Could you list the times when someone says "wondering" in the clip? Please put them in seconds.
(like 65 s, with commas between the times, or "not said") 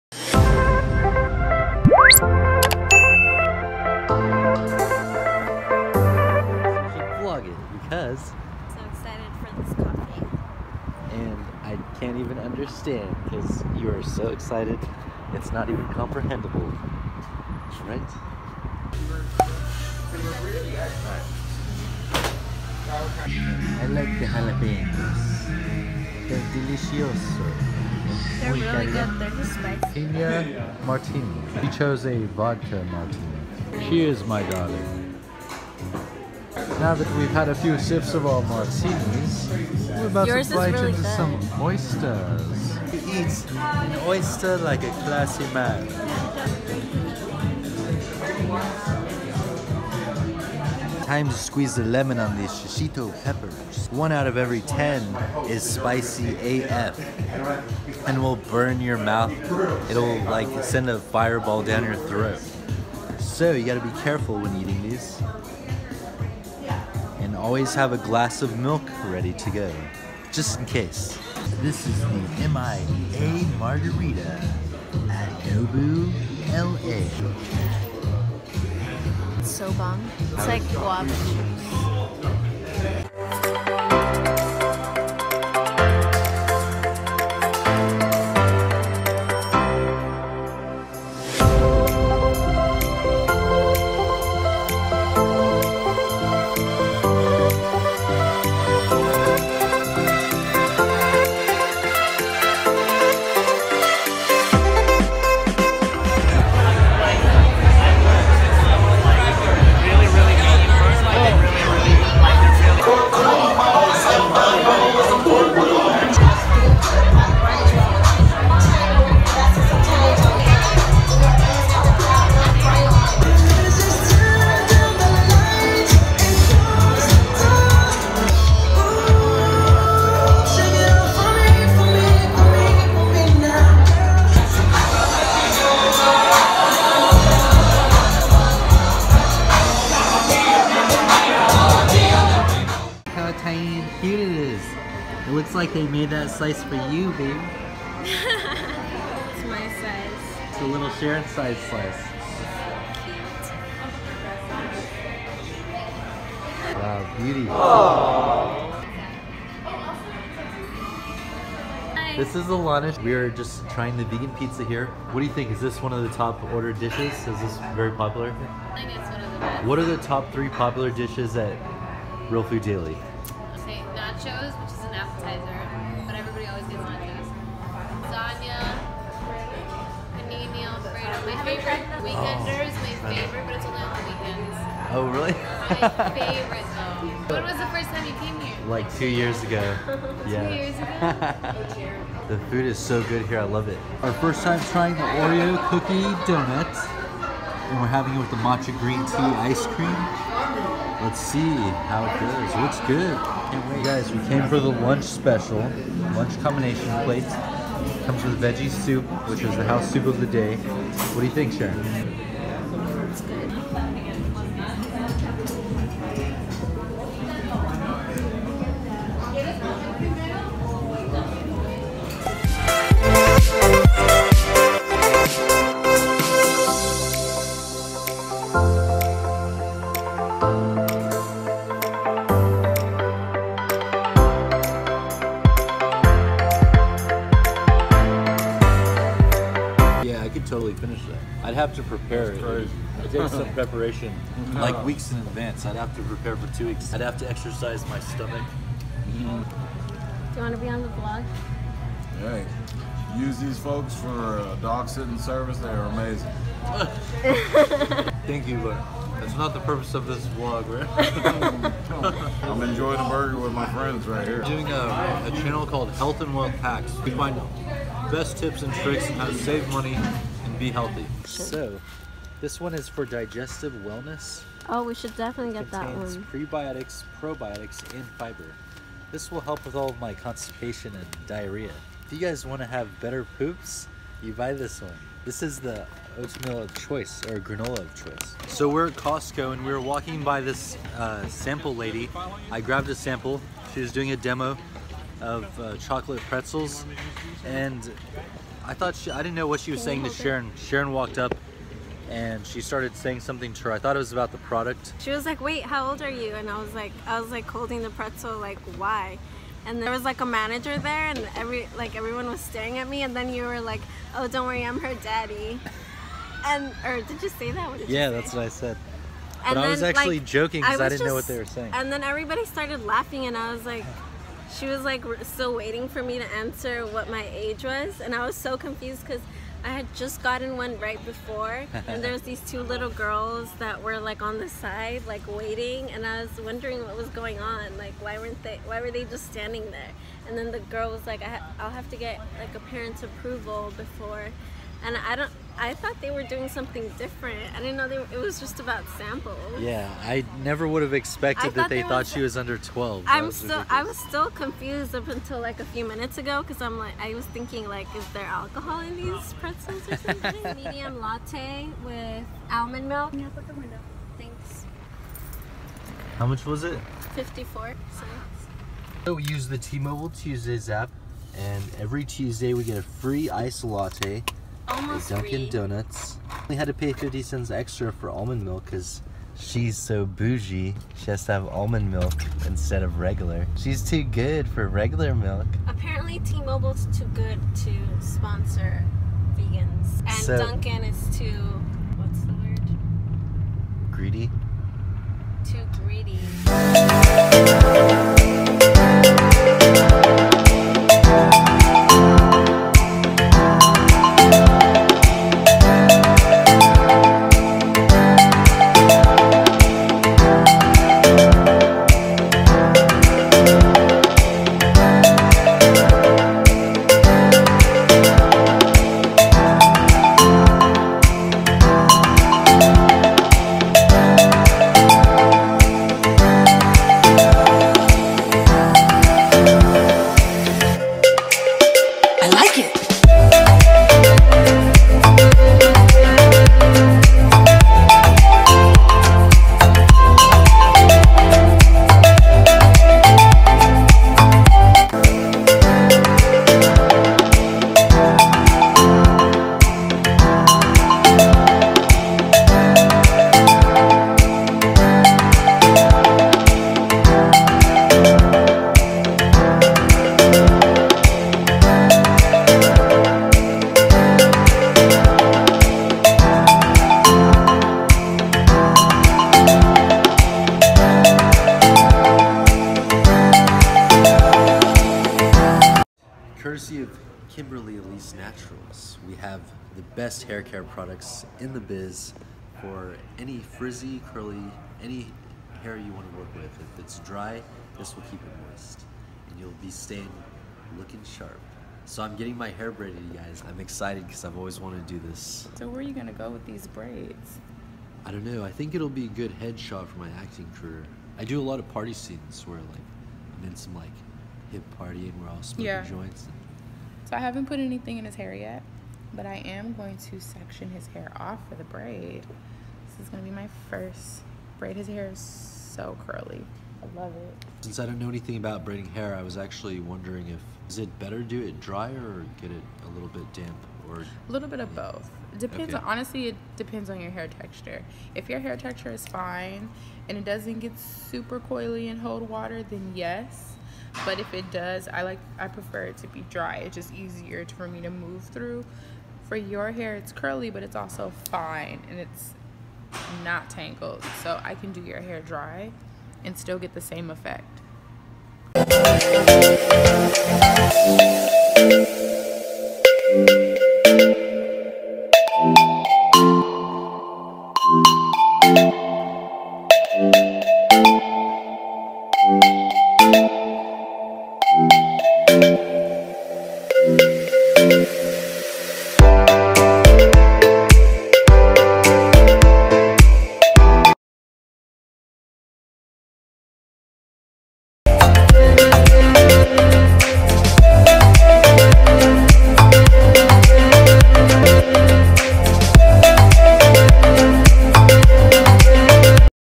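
336 s, 519 s.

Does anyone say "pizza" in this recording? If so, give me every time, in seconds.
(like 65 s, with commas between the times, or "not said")
164 s.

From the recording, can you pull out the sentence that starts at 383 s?
She's too good for regular milk.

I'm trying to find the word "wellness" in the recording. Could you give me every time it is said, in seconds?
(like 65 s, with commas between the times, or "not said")
273 s.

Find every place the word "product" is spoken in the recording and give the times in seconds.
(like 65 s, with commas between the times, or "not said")
304 s, 480 s.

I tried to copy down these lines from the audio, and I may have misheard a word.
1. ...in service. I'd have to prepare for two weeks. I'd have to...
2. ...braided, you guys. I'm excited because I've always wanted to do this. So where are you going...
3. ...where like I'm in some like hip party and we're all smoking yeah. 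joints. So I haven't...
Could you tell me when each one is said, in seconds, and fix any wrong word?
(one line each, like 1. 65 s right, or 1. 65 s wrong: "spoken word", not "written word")
1. 245 s wrong: "advance", not "service"
2. 492 s right
3. 502 s right.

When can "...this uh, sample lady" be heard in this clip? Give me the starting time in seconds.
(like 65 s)
290 s.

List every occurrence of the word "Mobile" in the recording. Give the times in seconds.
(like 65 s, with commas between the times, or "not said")
369 s, 386 s.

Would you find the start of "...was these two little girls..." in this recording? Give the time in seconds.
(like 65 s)
332 s.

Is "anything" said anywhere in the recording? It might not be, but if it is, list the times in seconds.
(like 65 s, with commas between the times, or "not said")
507 s, 518 s.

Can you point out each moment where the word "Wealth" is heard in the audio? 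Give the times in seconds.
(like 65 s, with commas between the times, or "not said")
266 s.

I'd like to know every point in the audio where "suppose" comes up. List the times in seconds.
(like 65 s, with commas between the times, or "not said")
not said.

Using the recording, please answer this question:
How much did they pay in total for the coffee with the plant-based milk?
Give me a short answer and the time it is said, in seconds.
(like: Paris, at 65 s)
54 cents, at 367 s.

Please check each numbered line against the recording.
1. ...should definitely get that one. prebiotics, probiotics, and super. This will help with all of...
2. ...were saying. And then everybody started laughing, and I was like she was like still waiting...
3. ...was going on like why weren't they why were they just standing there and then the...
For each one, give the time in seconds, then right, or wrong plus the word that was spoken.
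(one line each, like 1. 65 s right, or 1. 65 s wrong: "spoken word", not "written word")
1. 274 s wrong: "fiber", not "super"
2. 321 s right
3. 336 s right.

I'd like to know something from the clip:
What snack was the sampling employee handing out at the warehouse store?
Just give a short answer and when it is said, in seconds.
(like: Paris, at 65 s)
Chocolate pretzels, at 295 s.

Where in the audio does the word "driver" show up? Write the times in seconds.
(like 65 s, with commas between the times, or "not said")
not said.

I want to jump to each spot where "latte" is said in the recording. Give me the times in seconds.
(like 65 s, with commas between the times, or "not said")
360 s, 373 s.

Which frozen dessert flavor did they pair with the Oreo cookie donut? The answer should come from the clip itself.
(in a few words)
Matcha green tea.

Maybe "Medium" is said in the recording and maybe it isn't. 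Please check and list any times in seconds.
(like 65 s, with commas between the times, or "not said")
360 s.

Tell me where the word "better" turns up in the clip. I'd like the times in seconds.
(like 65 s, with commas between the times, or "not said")
282 s, 520 s.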